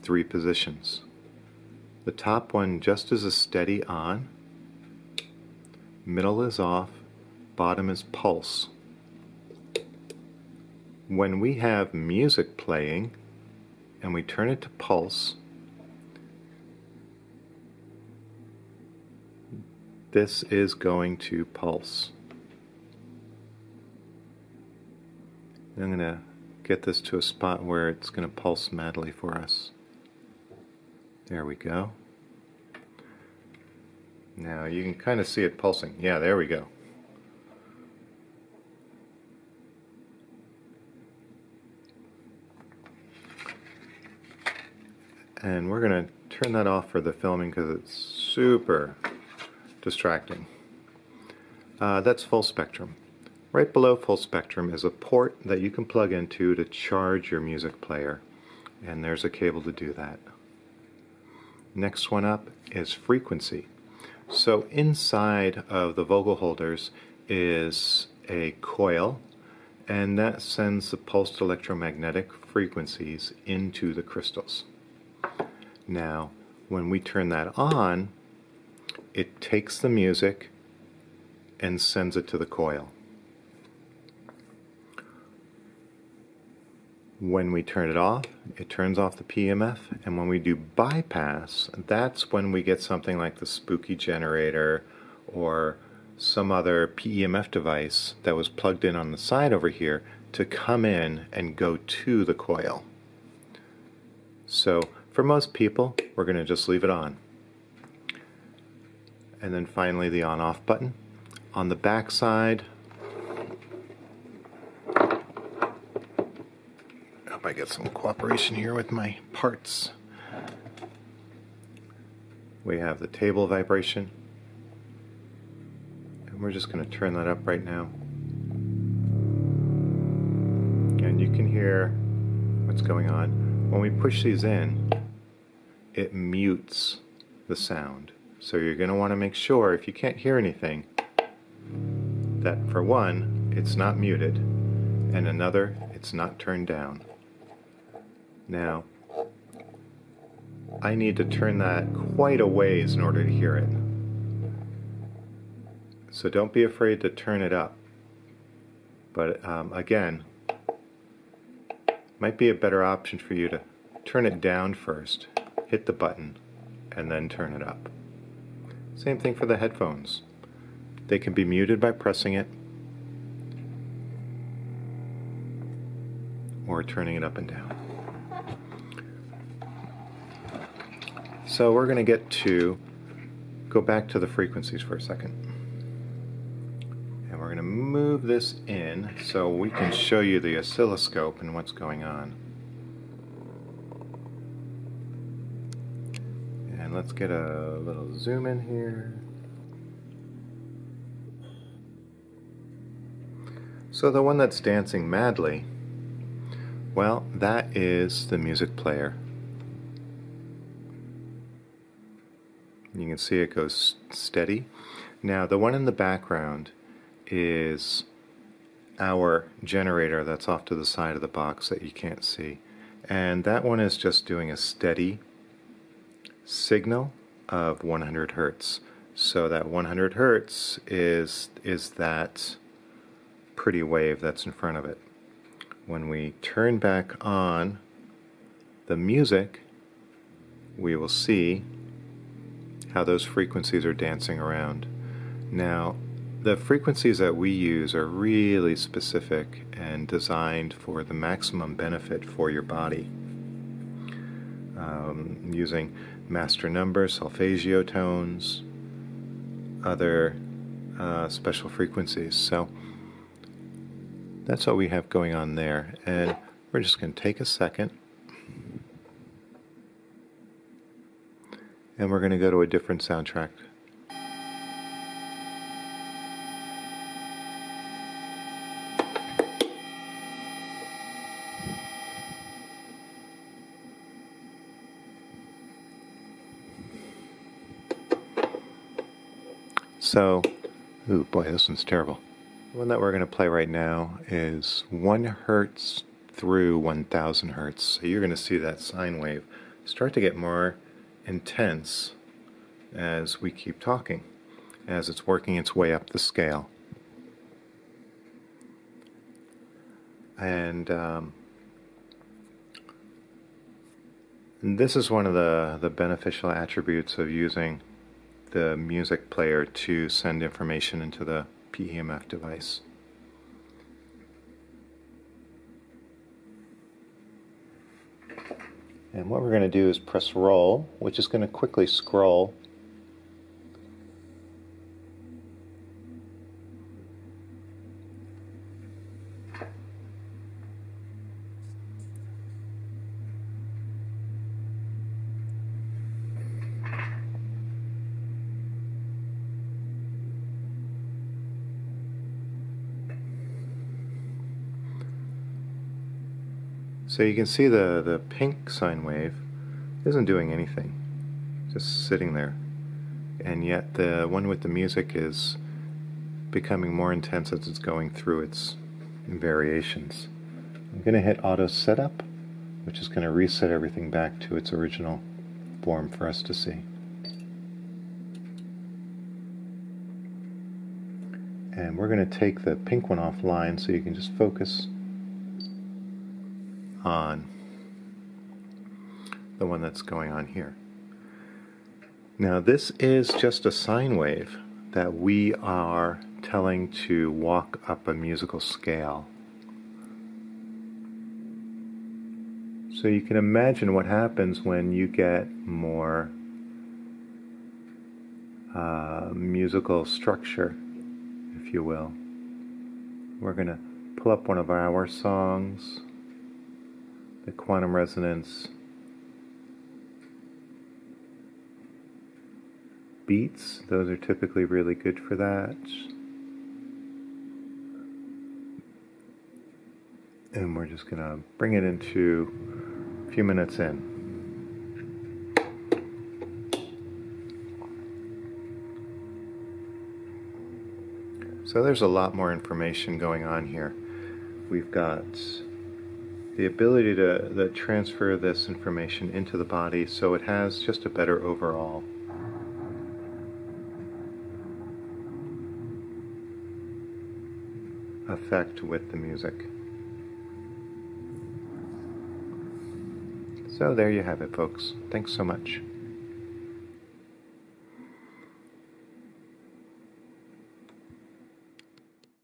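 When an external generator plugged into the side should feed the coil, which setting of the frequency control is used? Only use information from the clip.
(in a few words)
Bypass.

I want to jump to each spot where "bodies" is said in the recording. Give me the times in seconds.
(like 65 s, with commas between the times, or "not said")
not said.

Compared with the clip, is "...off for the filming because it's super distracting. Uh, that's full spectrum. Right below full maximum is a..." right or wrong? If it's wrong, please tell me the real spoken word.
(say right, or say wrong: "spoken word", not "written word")
wrong: "spectrum", not "maximum".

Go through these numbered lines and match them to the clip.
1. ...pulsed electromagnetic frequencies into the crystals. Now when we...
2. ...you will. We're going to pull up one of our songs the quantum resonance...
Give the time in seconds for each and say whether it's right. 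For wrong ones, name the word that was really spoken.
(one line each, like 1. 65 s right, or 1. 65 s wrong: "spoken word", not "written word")
1. 70 s right
2. 411 s right.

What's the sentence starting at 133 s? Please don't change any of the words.
When we push these in, it mutes the sound.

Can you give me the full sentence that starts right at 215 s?
Now, the one in the background is our generator that's off to the side of the box that you can't see.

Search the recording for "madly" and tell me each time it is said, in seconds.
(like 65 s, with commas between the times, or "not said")
28 s, 205 s.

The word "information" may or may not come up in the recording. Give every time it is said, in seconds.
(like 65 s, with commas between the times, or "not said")
320 s, 442 s, 448 s.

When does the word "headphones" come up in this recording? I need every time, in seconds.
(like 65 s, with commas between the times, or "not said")
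169 s.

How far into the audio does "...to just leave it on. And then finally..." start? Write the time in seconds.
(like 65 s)
106 s.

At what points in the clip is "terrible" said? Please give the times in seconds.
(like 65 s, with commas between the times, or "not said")
291 s.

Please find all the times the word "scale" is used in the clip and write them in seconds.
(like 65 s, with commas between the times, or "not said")
306 s, 398 s.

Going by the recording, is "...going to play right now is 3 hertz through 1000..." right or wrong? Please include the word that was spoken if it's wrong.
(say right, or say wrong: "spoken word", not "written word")
wrong: "1", not "3".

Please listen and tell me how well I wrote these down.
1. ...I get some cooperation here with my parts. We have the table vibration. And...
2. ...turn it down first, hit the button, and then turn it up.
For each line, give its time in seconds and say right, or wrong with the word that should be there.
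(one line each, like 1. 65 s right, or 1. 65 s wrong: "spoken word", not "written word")
1. 117 s right
2. 164 s right.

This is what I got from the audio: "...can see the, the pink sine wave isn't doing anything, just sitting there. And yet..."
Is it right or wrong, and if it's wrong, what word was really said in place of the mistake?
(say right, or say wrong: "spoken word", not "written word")
right.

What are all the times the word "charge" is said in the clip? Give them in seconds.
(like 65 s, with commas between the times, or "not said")
56 s.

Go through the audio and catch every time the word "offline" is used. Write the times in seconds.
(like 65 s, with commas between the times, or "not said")
383 s.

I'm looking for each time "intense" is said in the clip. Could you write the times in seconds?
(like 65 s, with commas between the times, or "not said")
301 s, 367 s.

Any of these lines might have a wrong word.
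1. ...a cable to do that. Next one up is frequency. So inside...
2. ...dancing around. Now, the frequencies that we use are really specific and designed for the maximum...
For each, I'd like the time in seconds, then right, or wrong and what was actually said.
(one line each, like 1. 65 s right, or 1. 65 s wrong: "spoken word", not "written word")
1. 59 s right
2. 243 s right.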